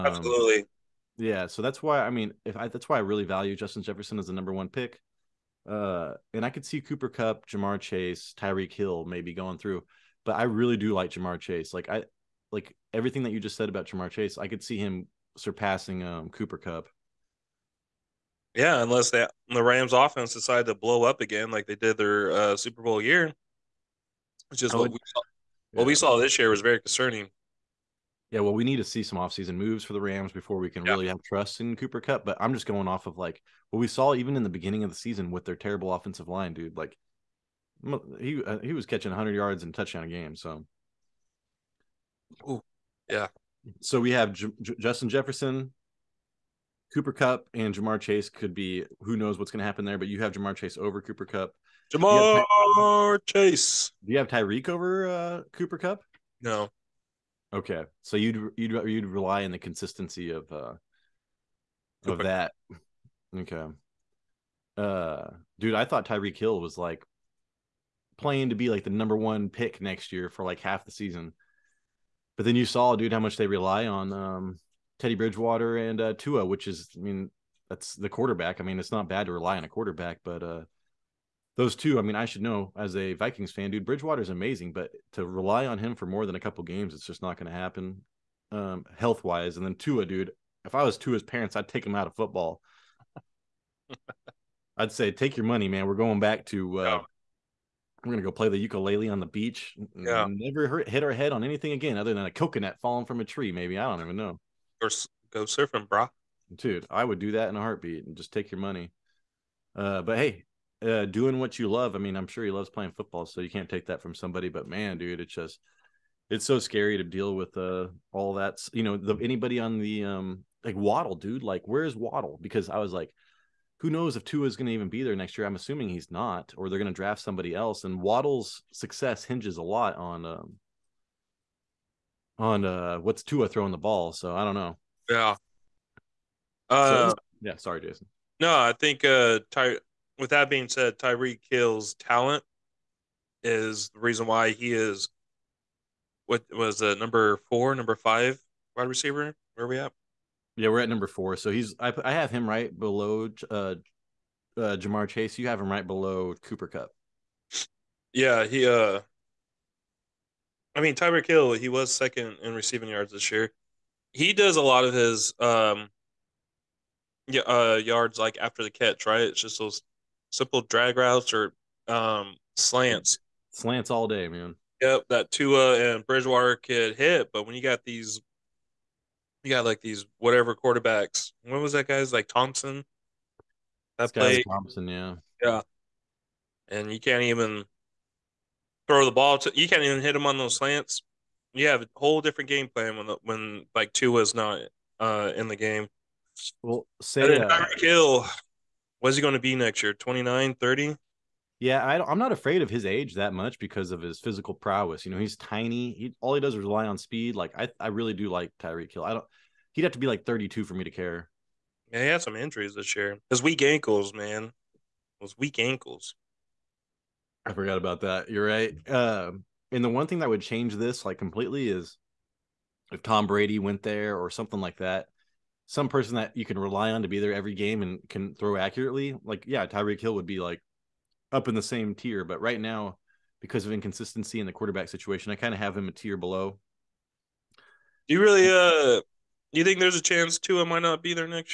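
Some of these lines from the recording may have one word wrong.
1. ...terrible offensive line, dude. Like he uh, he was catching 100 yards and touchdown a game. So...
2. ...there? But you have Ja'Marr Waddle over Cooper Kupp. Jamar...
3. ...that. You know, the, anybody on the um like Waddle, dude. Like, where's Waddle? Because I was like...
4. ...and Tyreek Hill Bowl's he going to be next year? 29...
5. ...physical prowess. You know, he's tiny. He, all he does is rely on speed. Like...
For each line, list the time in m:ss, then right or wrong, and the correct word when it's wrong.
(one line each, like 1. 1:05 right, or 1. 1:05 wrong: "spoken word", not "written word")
1. 0:35 right
2. 0:49 wrong: "Chase", not "Waddle"
3. 1:58 right
4. 3:17 wrong: "What", not "Bowl"
5. 3:24 right.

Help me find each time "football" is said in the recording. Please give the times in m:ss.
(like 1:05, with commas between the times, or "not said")
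1:32, 1:52.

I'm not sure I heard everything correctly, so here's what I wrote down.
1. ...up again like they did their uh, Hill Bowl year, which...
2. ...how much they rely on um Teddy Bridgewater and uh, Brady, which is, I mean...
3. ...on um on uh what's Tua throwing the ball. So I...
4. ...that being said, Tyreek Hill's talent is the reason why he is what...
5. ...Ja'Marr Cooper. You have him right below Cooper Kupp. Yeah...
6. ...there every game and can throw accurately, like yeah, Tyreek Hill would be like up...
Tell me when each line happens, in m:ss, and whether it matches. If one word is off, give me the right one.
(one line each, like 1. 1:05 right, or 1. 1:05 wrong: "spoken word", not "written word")
1. 0:21 wrong: "Super", not "Hill"
2. 1:13 wrong: "Tua", not "Brady"
3. 2:09 right
4. 2:20 right
5. 2:34 wrong: "Chase", not "Cooper"
6. 3:47 right.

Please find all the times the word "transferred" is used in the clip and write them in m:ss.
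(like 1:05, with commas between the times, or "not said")
not said.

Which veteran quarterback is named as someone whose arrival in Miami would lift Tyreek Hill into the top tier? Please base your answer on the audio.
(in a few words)
Tom Brady.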